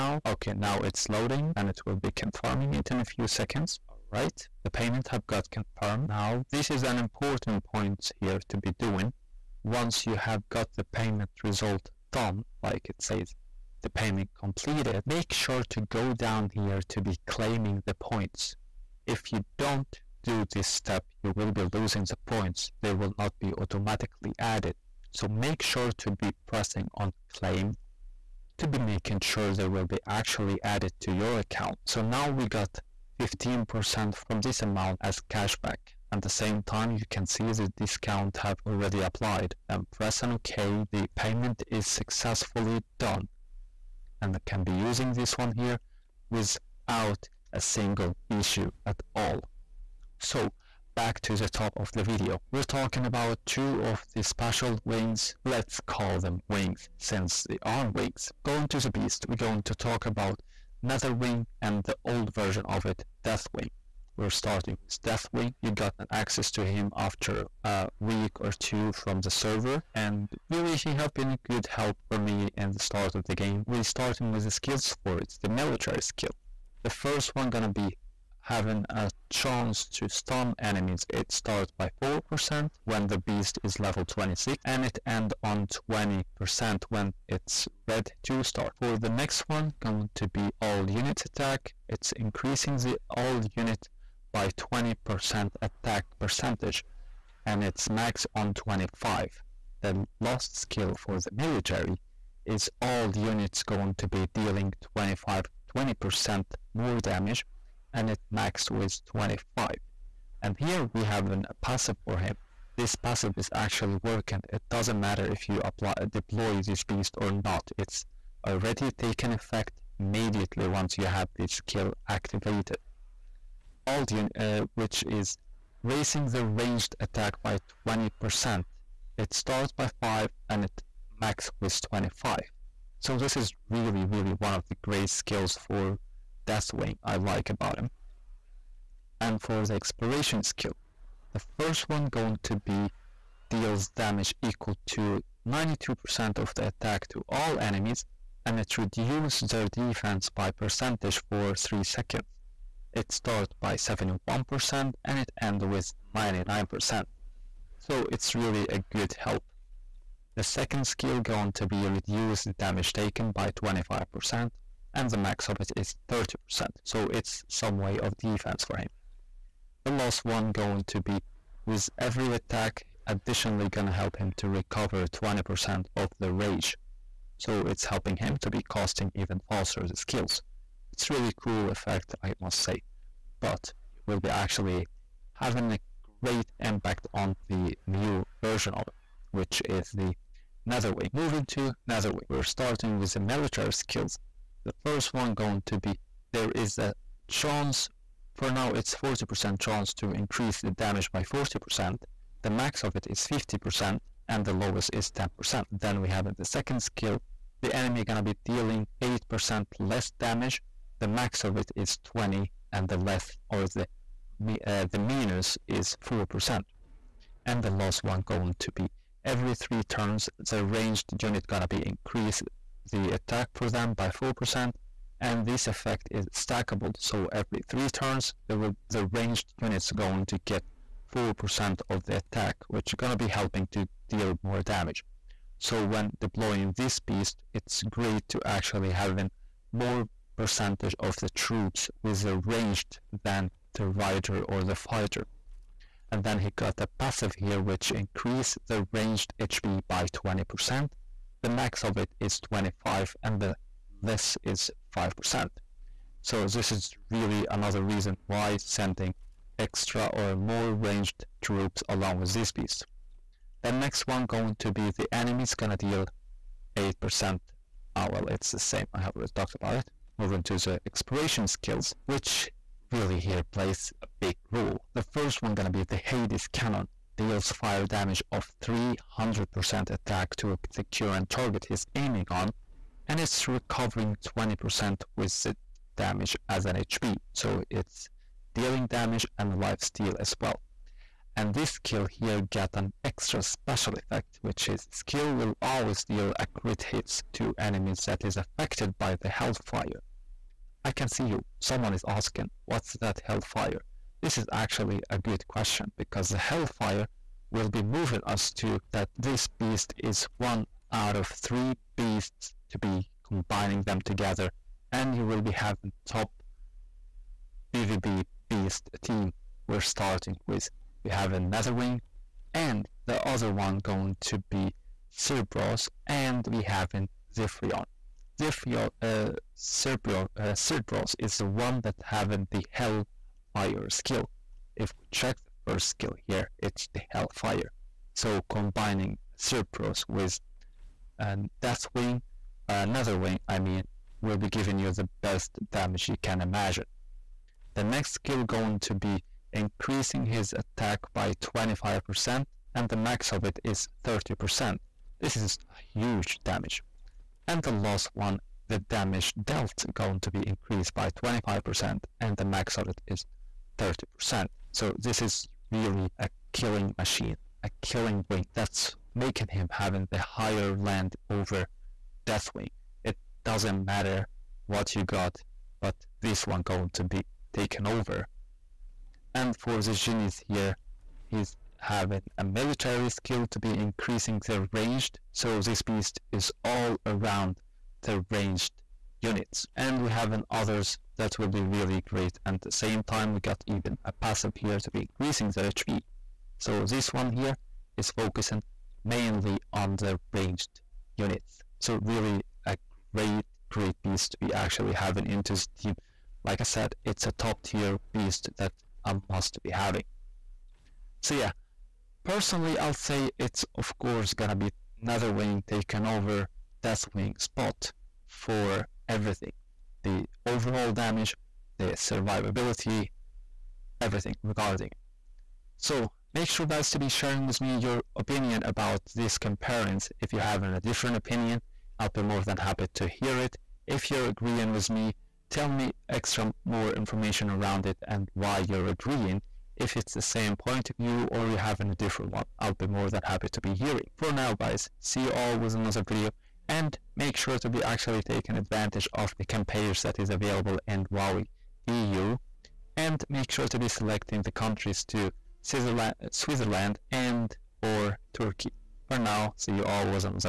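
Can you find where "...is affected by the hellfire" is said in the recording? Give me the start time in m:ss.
4:58.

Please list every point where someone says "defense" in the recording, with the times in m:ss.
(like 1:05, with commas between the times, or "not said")
2:29, 2:48.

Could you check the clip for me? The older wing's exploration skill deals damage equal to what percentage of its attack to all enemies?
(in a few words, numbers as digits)
92%.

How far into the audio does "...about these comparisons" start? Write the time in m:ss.
7:08.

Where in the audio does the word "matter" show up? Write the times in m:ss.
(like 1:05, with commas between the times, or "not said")
1:54, 6:13.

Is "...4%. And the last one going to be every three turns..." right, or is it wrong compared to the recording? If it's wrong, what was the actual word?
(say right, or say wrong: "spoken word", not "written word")
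right.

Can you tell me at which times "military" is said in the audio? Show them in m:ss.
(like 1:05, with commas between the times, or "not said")
1:15, 1:41, 3:13, 6:22.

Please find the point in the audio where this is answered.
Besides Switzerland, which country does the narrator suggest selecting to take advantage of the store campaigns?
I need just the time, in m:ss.
7:38.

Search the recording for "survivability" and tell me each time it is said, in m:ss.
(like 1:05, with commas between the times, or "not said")
7:01.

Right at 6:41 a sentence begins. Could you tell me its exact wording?
So really a great, great beast to be actually having into the team.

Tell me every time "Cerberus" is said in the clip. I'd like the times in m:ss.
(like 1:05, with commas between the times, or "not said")
5:25, 5:29, 5:39.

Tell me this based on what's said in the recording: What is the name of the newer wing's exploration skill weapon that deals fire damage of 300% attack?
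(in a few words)
Hades cannon.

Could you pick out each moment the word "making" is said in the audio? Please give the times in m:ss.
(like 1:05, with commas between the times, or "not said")
0:28, 6:09.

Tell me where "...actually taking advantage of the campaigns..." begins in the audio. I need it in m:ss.
7:27.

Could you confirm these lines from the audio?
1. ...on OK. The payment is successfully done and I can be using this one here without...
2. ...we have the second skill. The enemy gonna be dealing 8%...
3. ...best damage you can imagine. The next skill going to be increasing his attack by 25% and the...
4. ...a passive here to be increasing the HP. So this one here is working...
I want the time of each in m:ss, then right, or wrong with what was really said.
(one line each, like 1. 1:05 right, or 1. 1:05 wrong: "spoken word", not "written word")
1. 0:40 right
2. 3:26 right
3. 5:45 right
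4. 6:34 wrong: "focusing", not "working".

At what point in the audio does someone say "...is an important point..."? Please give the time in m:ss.
0:06.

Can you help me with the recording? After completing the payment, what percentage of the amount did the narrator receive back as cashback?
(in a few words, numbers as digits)
15%.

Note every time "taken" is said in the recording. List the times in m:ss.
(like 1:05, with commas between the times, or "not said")
1:58, 2:42, 6:17.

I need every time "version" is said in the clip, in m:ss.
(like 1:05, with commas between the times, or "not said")
1:02, 3:08.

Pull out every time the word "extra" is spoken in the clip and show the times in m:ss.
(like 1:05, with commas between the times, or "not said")
4:19, 4:53, 7:16.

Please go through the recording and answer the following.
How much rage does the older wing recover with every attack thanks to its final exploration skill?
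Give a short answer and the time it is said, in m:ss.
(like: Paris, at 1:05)
20%, at 2:55.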